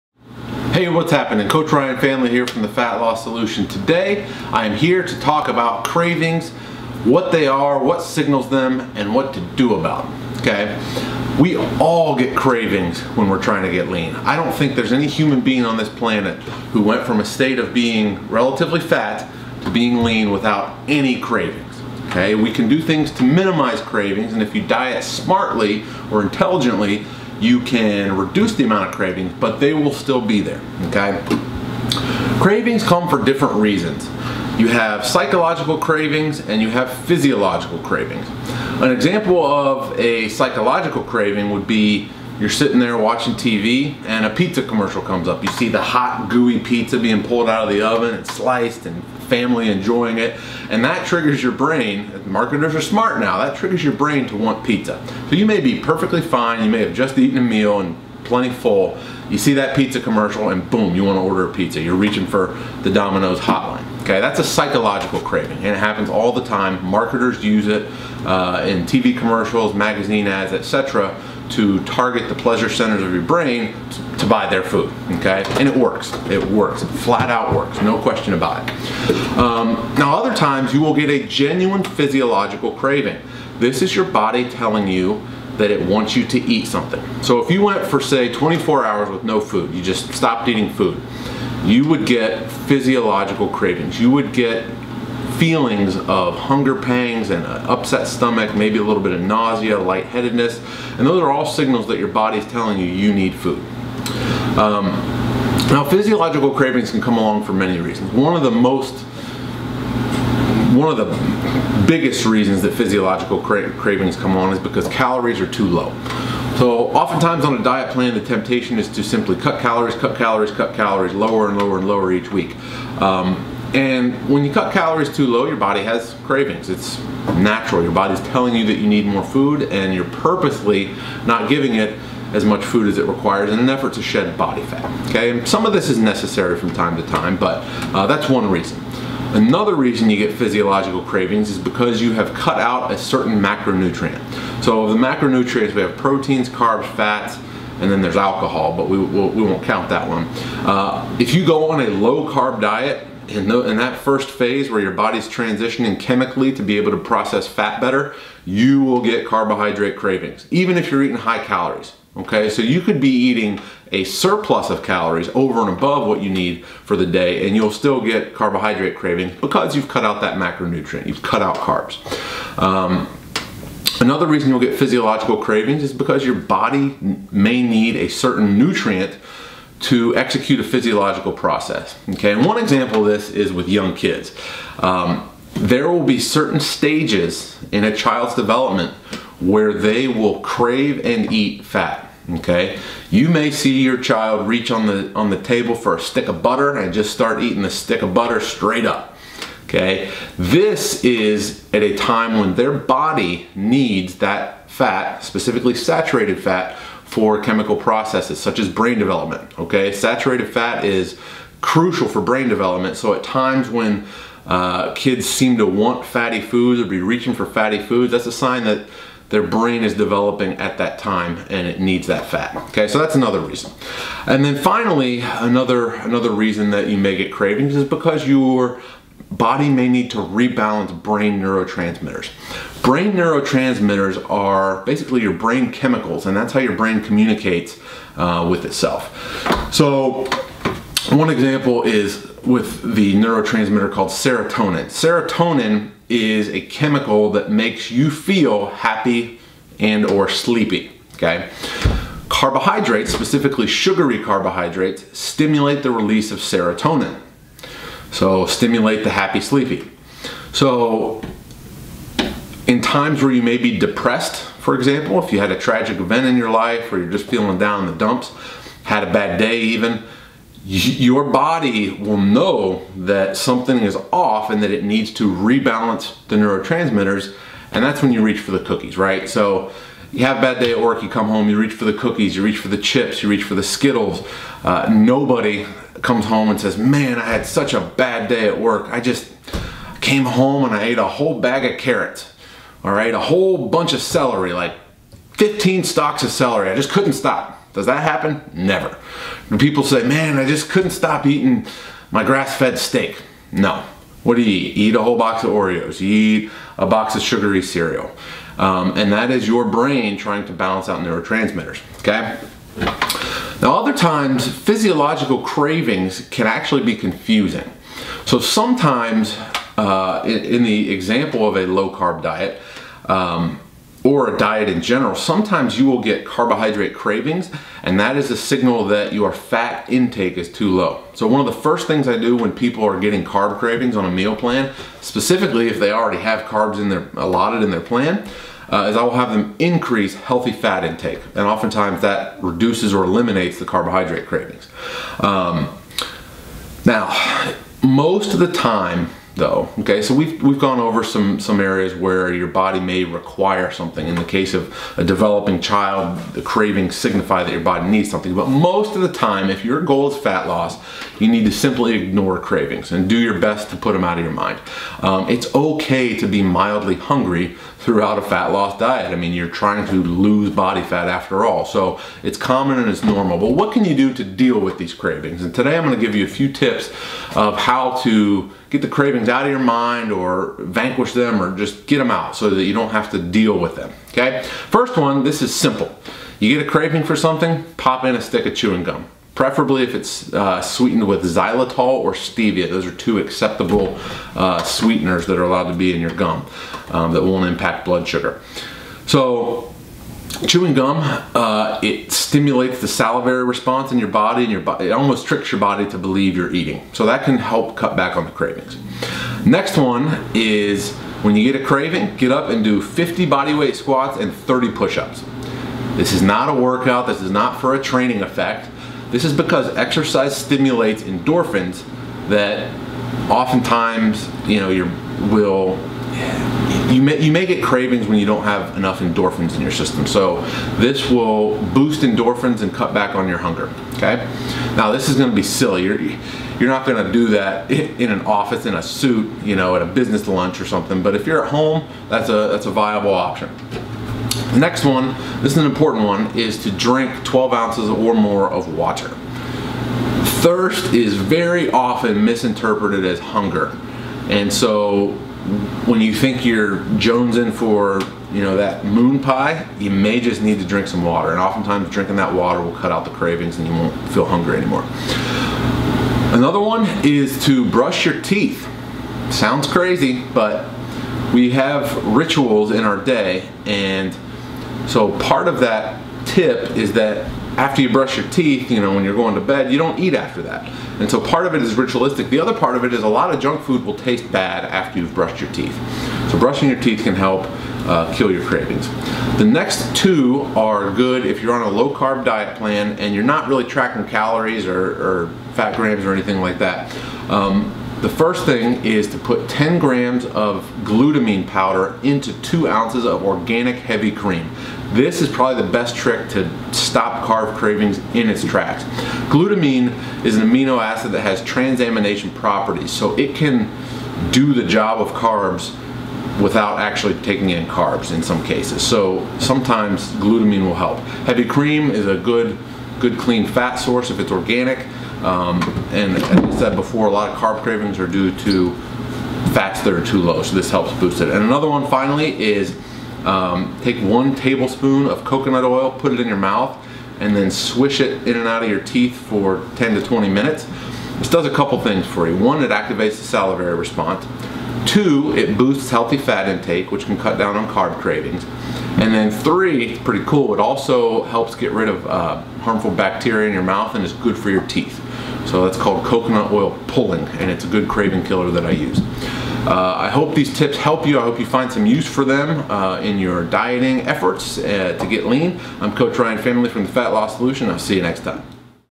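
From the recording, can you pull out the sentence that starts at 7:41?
And oftentimes drinking that water will cut out the cravings and you won't feel hungry anymore.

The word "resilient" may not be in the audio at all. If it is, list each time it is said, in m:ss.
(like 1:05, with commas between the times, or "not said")
not said.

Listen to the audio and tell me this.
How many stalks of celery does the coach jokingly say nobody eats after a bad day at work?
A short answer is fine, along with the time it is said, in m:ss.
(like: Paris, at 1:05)
15, at 4:55.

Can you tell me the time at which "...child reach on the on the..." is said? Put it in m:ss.
3:13.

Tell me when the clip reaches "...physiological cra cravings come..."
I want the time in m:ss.
1:52.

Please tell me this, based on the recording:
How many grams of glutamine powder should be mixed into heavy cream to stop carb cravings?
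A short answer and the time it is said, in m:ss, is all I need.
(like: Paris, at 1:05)
10, at 8:19.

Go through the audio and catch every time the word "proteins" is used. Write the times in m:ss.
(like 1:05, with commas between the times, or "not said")
2:25.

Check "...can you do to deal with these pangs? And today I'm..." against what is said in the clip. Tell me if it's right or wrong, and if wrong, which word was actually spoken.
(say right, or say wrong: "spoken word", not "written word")
wrong: "cravings", not "pangs".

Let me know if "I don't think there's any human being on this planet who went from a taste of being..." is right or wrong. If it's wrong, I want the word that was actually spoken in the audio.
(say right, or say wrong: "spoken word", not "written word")
wrong: "state", not "taste".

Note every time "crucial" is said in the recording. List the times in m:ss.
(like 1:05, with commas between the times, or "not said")
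3:31.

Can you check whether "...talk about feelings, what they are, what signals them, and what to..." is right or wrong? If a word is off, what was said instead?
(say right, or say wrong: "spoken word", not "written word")
wrong: "cravings", not "feelings".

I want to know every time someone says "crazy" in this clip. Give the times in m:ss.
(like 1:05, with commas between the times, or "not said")
7:49.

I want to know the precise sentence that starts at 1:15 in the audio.
And it works, it works, it flat out works, no question about it.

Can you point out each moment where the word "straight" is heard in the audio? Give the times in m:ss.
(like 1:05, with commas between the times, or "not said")
3:18.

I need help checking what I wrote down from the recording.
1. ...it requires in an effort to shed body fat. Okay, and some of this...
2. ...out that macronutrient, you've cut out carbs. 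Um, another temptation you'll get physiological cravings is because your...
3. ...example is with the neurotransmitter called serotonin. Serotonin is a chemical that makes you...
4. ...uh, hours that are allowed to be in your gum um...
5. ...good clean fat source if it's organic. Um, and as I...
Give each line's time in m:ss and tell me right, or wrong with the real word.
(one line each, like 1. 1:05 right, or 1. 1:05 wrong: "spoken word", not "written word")
1. 2:12 right
2. 2:50 wrong: "reason", not "temptation"
3. 4:01 right
4. 6:34 wrong: "sweeteners", not "hours"
5. 8:42 right.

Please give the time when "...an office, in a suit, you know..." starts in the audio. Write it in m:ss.
7:18.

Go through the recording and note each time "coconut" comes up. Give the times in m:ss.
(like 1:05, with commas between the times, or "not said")
8:55, 9:16.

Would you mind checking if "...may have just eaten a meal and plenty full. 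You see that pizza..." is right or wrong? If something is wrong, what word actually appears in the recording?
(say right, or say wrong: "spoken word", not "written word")
right.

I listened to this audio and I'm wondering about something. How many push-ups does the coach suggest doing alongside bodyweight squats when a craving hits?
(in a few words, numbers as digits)
30.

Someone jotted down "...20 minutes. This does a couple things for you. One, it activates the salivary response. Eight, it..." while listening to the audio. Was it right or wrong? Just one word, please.
wrong.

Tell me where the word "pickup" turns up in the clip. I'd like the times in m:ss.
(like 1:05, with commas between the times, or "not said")
not said.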